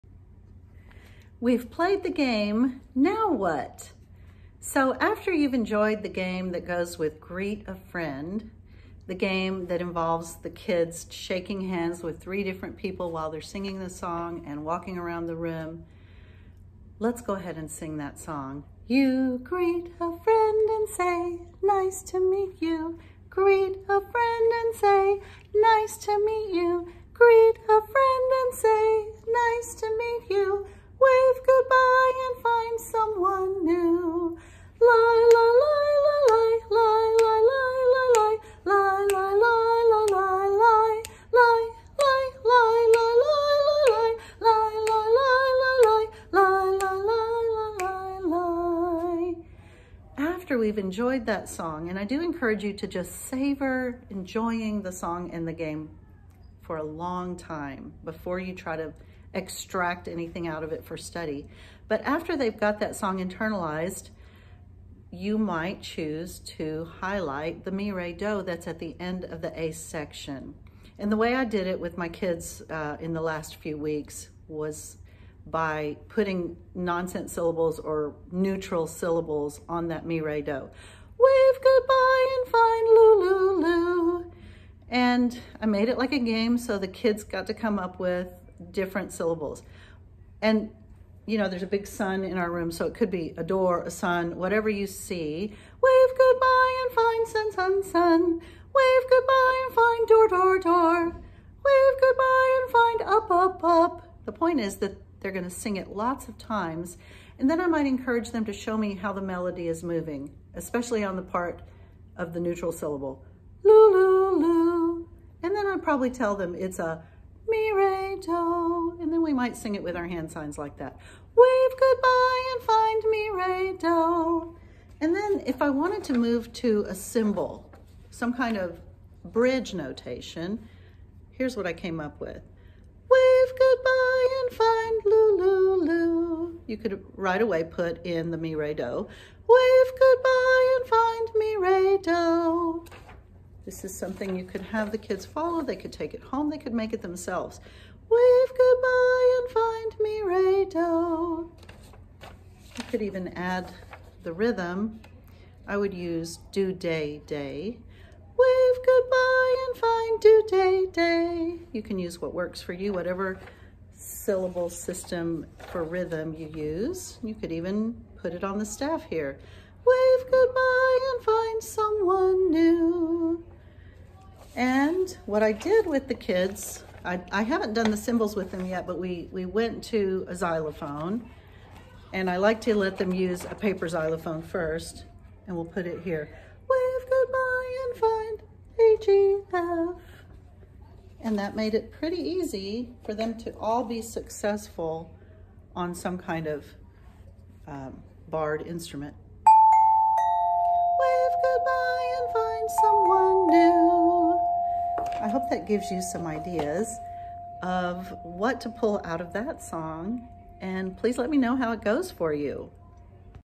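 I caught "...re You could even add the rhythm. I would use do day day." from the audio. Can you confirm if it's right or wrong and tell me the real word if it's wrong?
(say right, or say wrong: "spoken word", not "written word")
right.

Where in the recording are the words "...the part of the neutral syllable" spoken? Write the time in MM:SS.
01:51.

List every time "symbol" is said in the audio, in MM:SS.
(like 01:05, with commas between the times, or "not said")
02:06, 02:57.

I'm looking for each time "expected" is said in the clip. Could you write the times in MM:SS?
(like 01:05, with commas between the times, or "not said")
not said.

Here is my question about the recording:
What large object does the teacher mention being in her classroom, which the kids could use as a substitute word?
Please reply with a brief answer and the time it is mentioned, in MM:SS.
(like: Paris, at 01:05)
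A big sun, at 01:31.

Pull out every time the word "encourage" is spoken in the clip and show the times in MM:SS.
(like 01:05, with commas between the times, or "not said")
00:52, 01:47.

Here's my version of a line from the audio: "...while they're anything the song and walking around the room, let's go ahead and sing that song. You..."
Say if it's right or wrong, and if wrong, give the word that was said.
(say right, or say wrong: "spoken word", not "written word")
wrong: "singing", not "anything".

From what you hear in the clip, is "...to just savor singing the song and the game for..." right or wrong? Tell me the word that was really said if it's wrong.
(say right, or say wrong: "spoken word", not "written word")
wrong: "enjoying", not "singing".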